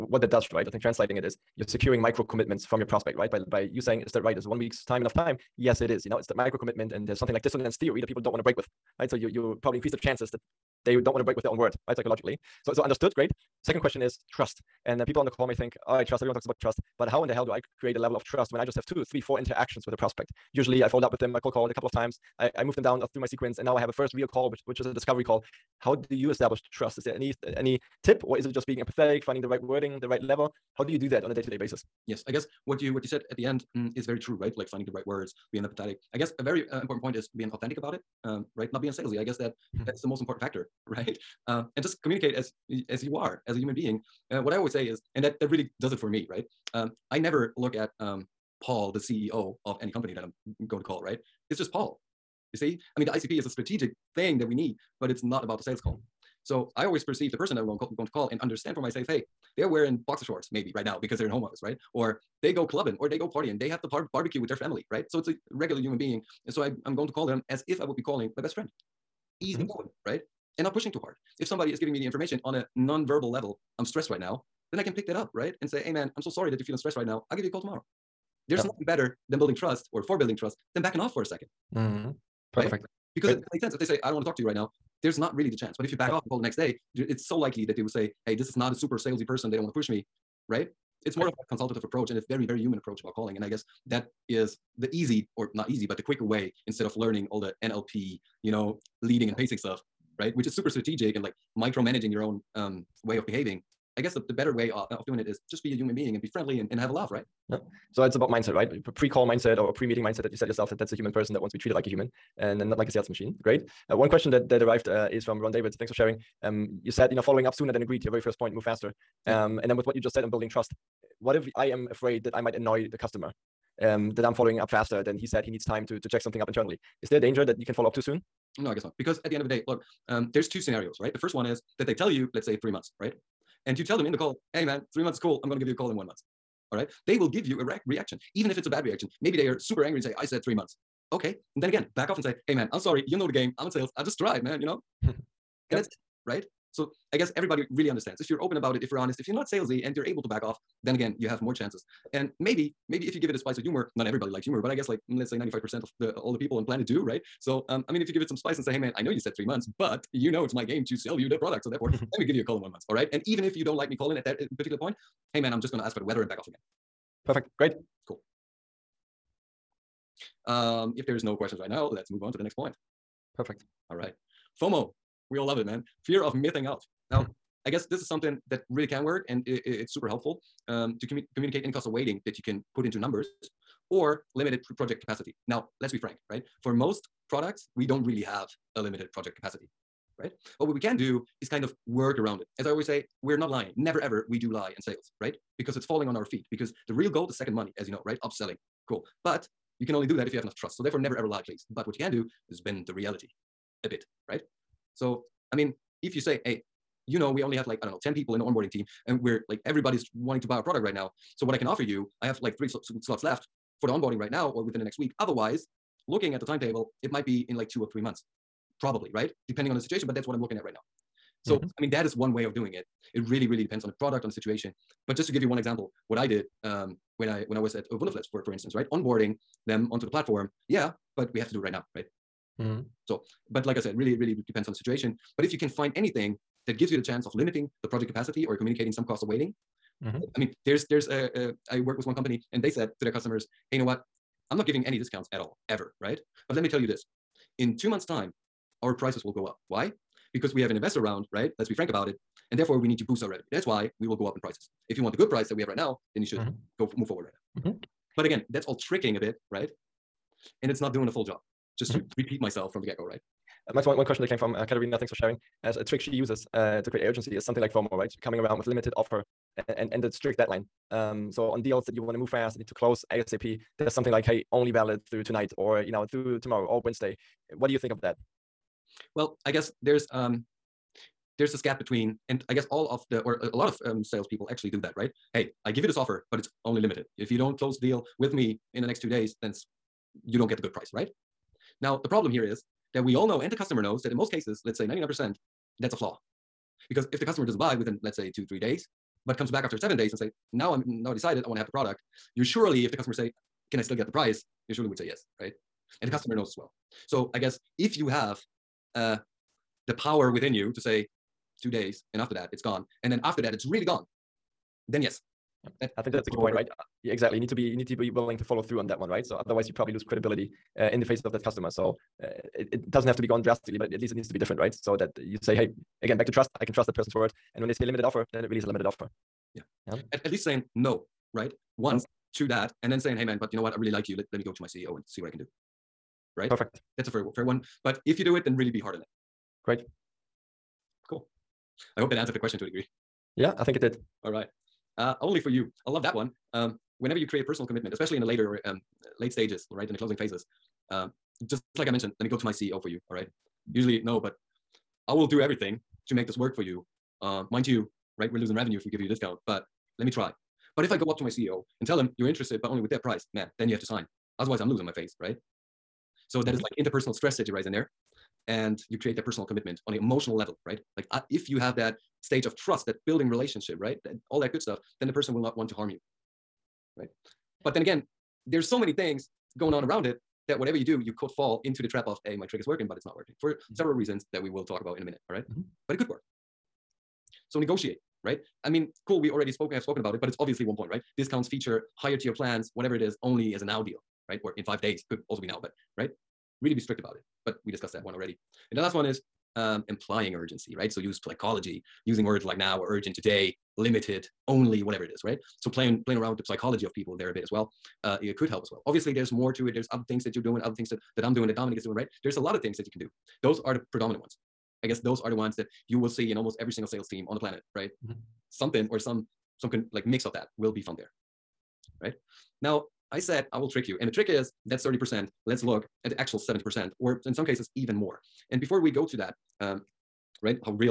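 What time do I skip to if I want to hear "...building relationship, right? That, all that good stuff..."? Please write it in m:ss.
6:13.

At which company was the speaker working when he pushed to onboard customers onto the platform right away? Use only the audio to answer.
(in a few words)
Wunderflats.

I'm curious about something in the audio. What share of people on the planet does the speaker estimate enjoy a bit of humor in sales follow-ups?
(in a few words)
95%.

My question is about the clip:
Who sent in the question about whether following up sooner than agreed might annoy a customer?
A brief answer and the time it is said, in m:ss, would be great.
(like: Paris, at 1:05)
Ron David, at 1:55.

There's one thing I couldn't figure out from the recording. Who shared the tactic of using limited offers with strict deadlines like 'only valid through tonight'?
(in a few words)
Katerina.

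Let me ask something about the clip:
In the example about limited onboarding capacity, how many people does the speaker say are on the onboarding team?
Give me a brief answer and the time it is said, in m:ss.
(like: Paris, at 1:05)
10, at 3:28.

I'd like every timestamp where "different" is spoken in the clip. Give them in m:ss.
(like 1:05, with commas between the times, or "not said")
5:24.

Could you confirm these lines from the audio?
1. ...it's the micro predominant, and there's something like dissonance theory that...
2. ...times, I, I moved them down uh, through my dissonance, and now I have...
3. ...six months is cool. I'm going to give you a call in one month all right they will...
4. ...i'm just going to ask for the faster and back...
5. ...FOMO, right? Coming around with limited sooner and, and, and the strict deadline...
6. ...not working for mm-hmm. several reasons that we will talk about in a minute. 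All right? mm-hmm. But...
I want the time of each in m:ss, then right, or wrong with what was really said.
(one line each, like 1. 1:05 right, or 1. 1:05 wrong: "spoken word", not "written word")
1. 0:06 wrong: "commitment", not "predominant"
2. 0:21 wrong: "sequence", not "dissonance"
3. 2:14 wrong: "three", not "six"
4. 2:45 wrong: "weather", not "faster"
5. 4:27 wrong: "offer", not "sooner"
6. 6:23 right.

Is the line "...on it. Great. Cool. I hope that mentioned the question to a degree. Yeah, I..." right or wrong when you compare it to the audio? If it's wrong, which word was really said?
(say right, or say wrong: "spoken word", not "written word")
wrong: "answered", not "mentioned".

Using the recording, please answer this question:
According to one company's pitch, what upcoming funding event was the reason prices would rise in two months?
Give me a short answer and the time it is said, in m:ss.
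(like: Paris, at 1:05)
investor round, at 4:10.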